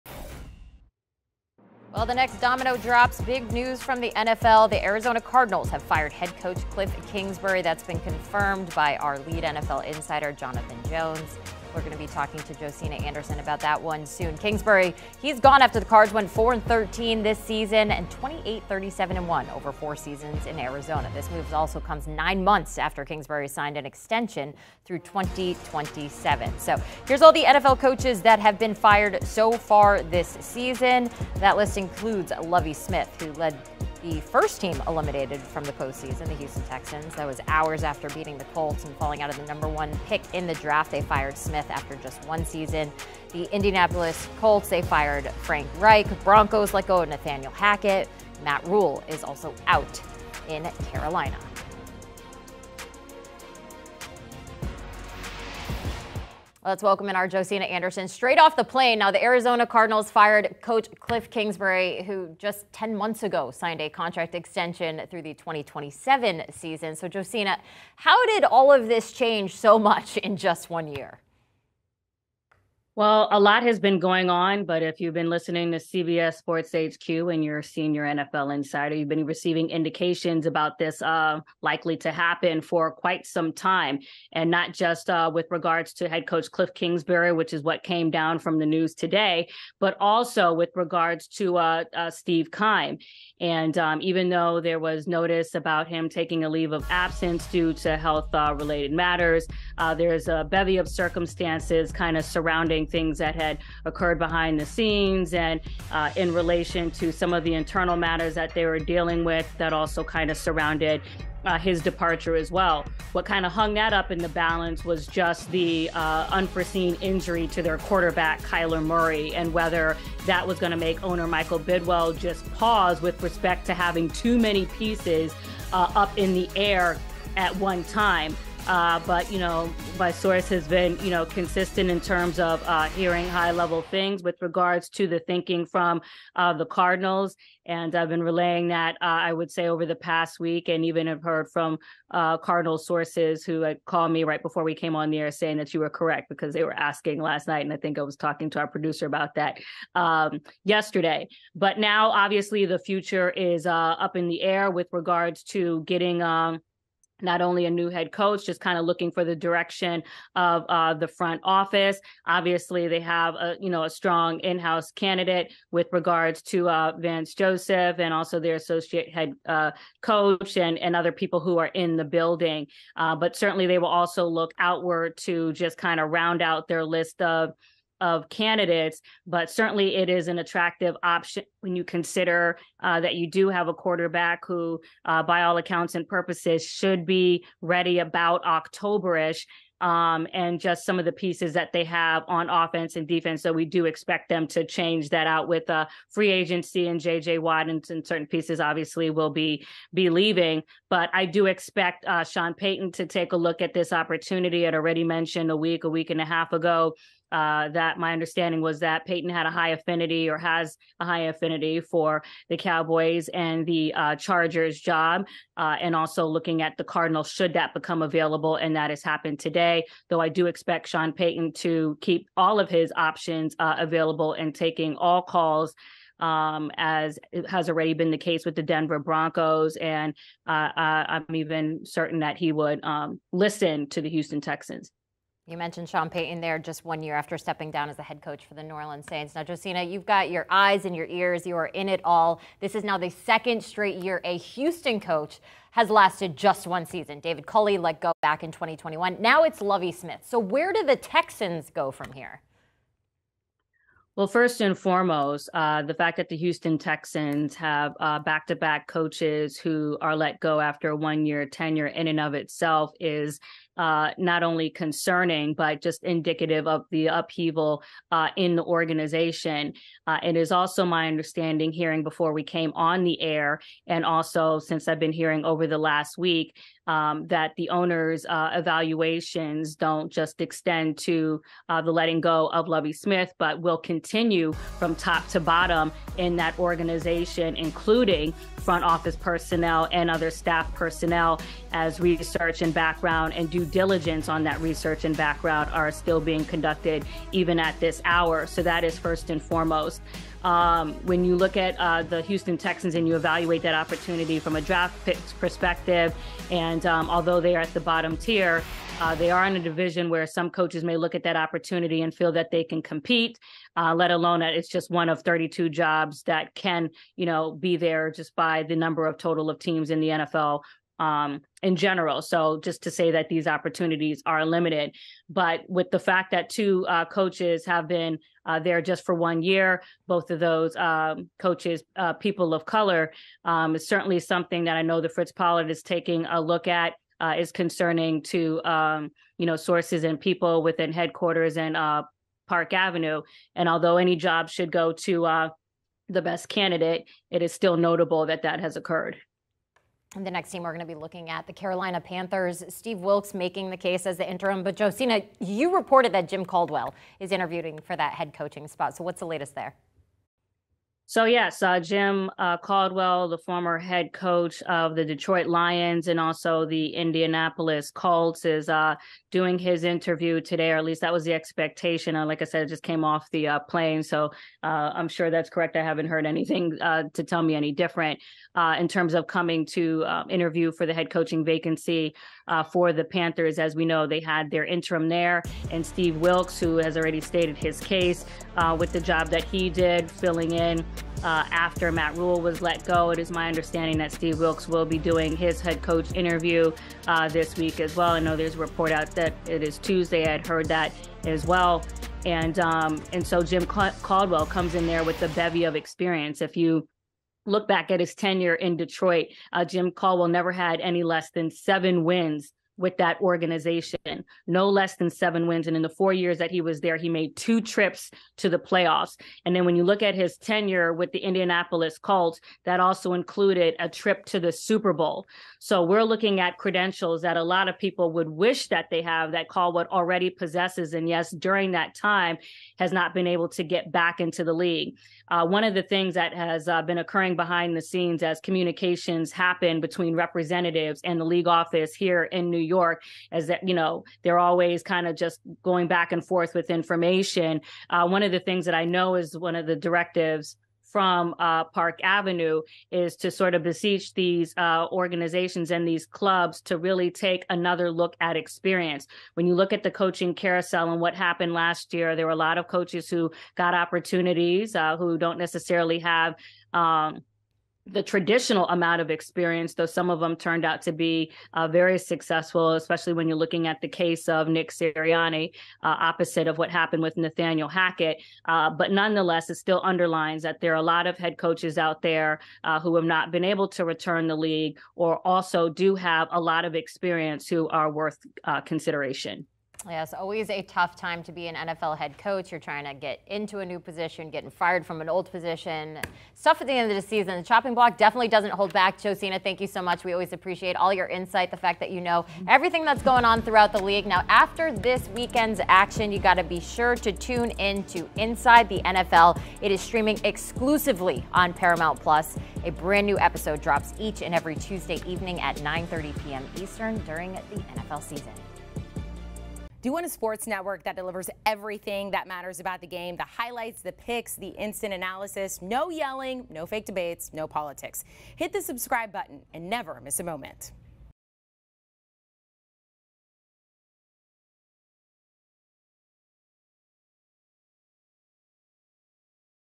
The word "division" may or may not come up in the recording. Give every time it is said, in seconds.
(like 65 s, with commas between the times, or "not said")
309 s.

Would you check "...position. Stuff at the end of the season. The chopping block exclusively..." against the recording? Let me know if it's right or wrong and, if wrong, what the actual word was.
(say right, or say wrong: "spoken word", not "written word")
wrong: "definitely", not "exclusively".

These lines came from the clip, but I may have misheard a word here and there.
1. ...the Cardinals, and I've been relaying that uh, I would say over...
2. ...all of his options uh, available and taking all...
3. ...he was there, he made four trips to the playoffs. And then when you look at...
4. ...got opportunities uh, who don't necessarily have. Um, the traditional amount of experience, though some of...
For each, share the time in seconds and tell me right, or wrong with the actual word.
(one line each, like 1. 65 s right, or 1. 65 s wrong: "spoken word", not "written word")
1. 136 s right
2. 222 s right
3. 416 s wrong: "two", not "four"
4. 463 s right.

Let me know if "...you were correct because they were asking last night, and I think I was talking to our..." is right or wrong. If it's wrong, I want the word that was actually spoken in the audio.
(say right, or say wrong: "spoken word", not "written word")
right.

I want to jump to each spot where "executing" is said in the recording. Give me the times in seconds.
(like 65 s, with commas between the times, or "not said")
not said.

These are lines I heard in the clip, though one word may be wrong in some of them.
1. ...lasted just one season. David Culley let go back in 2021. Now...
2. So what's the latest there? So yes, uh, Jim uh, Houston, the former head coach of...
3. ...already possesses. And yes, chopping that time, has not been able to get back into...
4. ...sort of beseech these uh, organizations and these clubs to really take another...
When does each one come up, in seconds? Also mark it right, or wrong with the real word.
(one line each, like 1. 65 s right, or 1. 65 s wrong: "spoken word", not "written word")
1. 245 s right
2. 358 s wrong: "Caldwell", not "Houston"
3. 429 s wrong: "during", not "chopping"
4. 453 s right.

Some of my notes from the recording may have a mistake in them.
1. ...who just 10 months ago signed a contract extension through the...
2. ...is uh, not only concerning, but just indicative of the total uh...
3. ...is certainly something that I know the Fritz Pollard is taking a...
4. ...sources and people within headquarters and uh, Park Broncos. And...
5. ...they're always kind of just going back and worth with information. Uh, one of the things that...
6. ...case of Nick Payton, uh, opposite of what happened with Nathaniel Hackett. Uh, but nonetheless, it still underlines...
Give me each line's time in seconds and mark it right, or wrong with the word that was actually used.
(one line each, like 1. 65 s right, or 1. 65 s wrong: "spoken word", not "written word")
1. 62 s right
2. 262 s wrong: "upheaval", not "total"
3. 333 s right
4. 339 s wrong: "Avenue", not "Broncos"
5. 444 s wrong: "forth", not "worth"
6. 473 s wrong: "Sirianni", not "Payton".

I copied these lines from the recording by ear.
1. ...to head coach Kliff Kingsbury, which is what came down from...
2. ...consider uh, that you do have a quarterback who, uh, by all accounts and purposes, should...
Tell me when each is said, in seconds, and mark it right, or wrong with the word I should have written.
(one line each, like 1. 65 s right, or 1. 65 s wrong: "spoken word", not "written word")
1. 85 s right
2. 181 s right.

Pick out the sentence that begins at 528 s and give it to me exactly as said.
Hit the subscribe button and never miss a moment.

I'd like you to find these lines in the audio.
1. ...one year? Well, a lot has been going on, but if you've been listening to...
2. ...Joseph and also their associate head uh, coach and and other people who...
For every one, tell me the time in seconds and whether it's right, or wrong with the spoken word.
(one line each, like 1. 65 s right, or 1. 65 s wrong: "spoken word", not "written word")
1. 70 s right
2. 167 s right.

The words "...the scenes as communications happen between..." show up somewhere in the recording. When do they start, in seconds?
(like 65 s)
437 s.